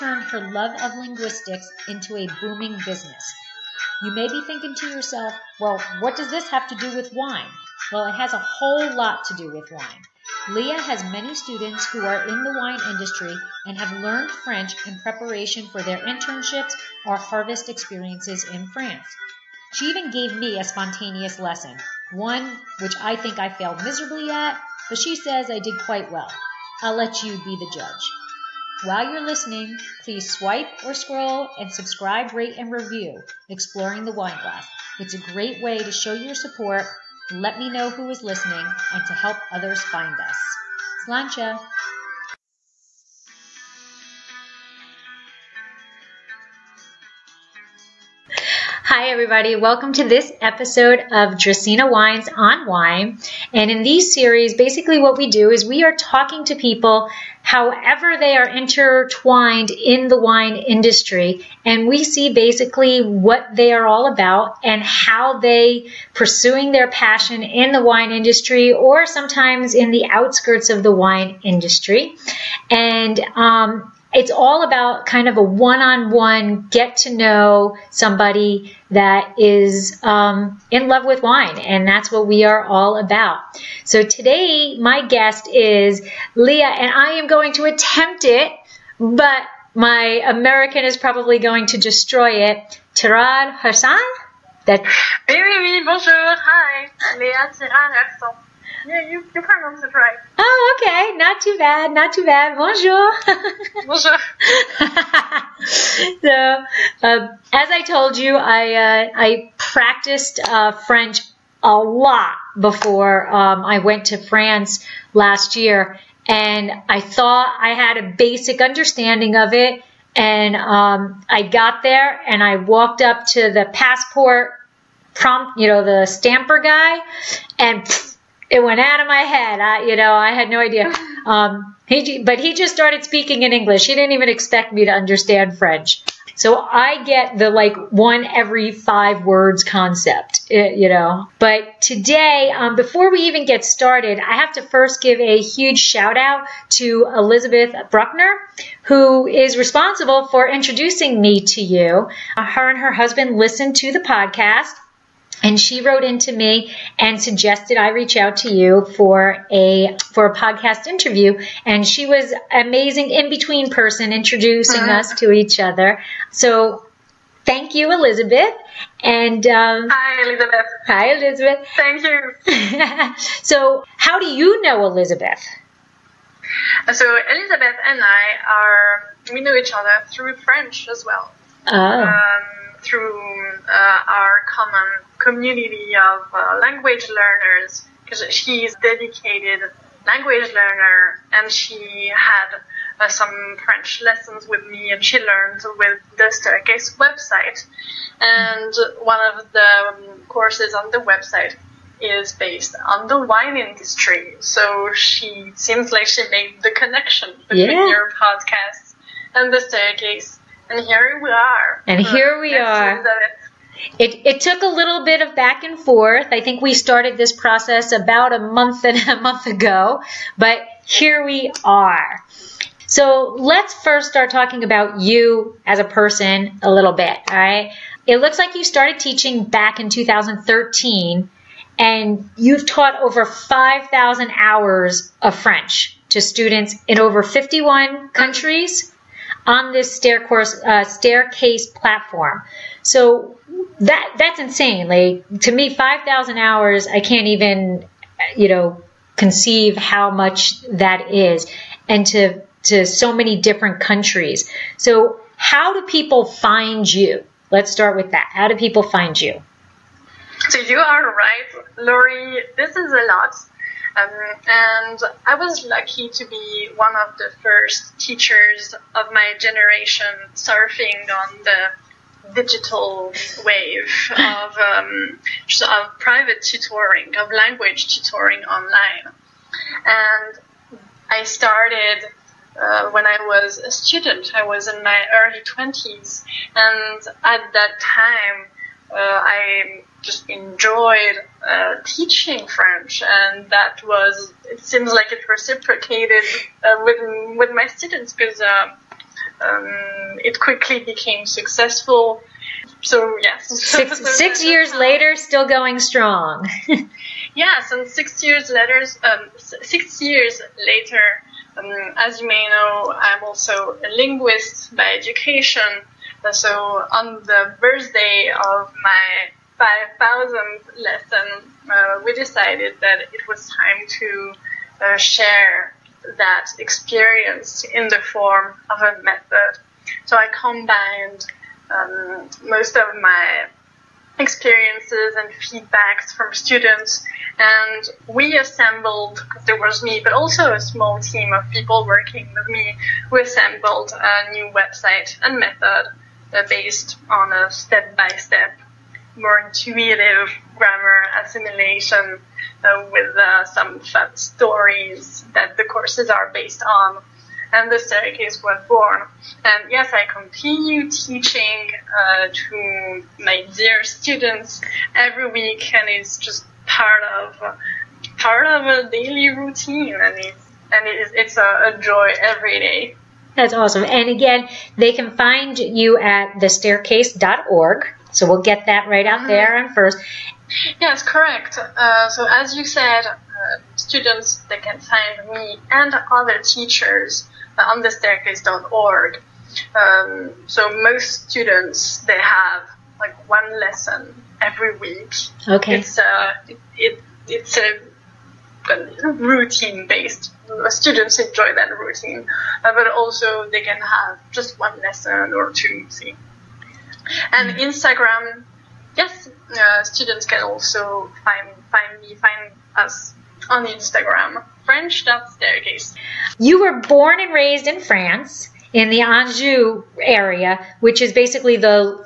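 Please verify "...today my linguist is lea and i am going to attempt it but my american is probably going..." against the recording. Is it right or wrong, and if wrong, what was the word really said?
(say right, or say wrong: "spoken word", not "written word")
wrong: "guest", not "linguist".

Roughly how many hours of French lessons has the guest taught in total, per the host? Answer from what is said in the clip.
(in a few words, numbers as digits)
5,000.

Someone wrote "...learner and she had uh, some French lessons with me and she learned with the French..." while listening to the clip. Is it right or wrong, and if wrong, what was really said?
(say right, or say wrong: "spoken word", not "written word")
wrong: "Staircase", not "French".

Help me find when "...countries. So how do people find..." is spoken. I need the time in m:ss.
4:13.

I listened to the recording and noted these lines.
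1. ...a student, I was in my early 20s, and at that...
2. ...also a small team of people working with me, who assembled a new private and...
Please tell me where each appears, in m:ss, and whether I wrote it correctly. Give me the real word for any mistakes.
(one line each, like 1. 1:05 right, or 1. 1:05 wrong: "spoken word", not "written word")
1. 4:43 right
2. 5:40 wrong: "website", not "private".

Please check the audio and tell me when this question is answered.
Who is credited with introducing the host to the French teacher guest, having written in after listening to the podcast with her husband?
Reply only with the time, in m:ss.
2:27.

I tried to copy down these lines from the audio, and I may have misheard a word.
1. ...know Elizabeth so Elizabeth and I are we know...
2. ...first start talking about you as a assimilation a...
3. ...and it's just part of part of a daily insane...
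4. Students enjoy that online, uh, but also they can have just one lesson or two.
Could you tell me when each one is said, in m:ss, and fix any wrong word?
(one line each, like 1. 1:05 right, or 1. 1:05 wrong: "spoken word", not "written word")
1. 2:54 right
2. 3:43 wrong: "person", not "assimilation"
3. 6:05 wrong: "routine", not "insane"
4. 6:40 wrong: "routine", not "online".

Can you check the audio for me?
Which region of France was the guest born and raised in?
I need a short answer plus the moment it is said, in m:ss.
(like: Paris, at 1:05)
Anjou, at 6:59.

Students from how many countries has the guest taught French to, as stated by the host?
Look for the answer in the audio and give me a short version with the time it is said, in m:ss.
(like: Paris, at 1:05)
51, at 3:57.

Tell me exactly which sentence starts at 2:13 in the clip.
He didn't even expect me to understand French.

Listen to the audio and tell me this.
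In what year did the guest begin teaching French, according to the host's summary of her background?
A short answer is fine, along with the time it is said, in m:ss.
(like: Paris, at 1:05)
2013, at 3:49.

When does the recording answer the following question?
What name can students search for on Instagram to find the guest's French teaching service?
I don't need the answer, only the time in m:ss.
6:54.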